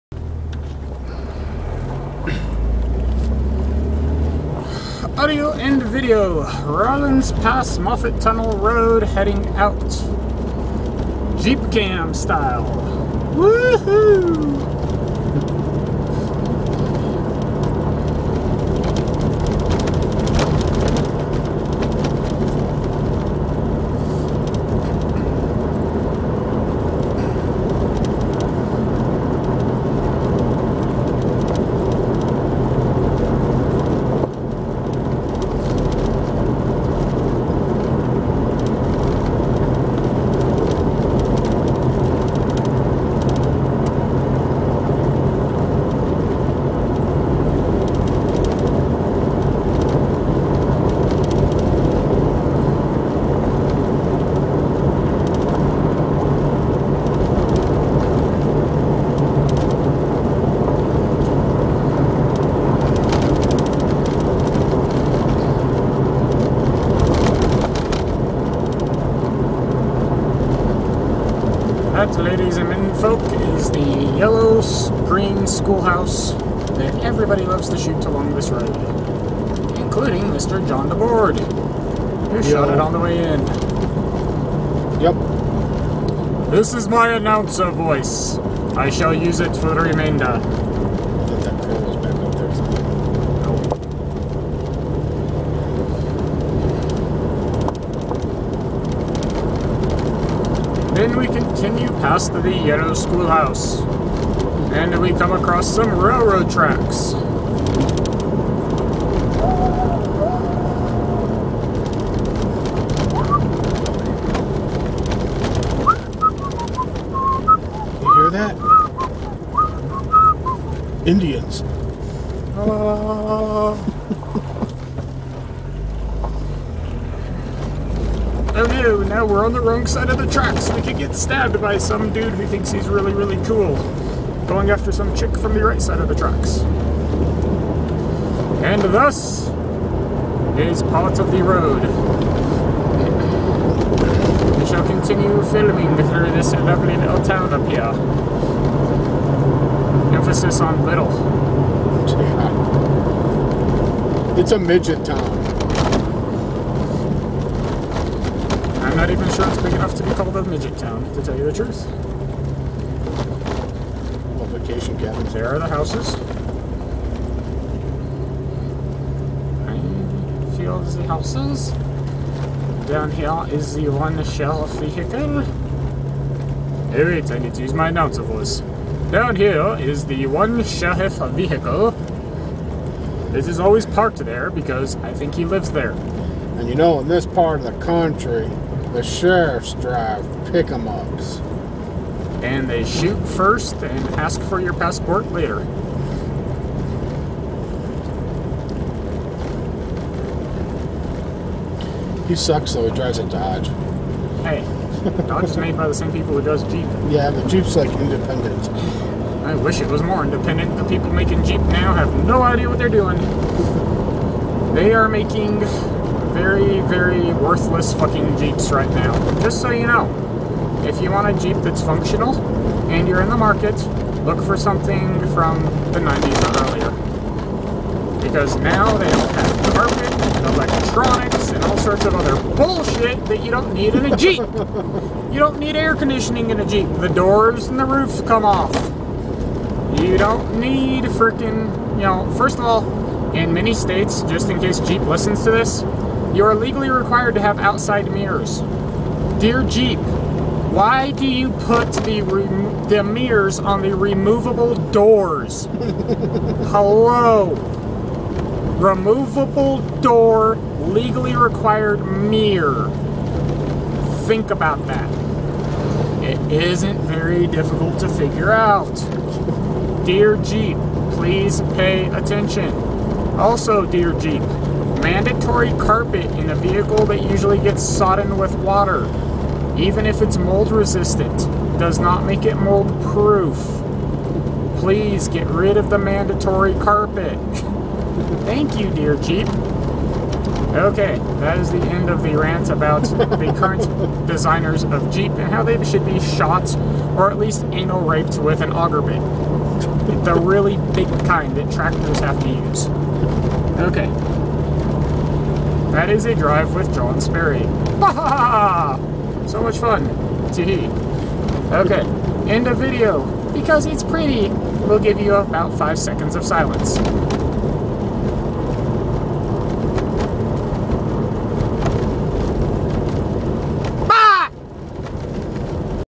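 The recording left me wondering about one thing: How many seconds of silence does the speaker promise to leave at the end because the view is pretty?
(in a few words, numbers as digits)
5.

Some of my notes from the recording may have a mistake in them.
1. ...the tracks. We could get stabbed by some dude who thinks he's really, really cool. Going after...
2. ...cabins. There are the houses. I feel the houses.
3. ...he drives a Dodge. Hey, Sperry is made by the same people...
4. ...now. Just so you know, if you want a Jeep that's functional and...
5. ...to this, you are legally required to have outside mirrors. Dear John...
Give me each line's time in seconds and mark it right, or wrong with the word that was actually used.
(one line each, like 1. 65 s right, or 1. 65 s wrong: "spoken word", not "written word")
1. 130 s right
2. 164 s right
3. 202 s wrong: "Dodge", not "Sperry"
4. 218 s right
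5. 245 s wrong: "Jeep", not "John".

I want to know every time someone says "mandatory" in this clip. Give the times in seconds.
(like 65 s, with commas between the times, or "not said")
275 s, 285 s.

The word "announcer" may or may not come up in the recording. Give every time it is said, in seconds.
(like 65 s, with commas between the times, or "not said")
87 s, 177 s.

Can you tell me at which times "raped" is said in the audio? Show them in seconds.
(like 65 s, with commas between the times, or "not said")
298 s.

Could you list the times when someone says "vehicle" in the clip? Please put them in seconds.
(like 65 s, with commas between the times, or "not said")
174 s, 181 s, 276 s.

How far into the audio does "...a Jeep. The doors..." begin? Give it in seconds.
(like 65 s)
236 s.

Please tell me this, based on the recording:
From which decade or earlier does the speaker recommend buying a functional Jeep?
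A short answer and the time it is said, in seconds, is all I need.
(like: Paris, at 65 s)
the 90s, at 225 s.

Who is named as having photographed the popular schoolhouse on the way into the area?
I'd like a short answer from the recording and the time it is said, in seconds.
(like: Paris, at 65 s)
John DeBoard, at 80 s.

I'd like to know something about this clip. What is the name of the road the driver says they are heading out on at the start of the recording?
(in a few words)
Rollins Pass Moffat Tunnel Road.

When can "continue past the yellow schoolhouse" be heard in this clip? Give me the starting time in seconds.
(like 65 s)
101 s.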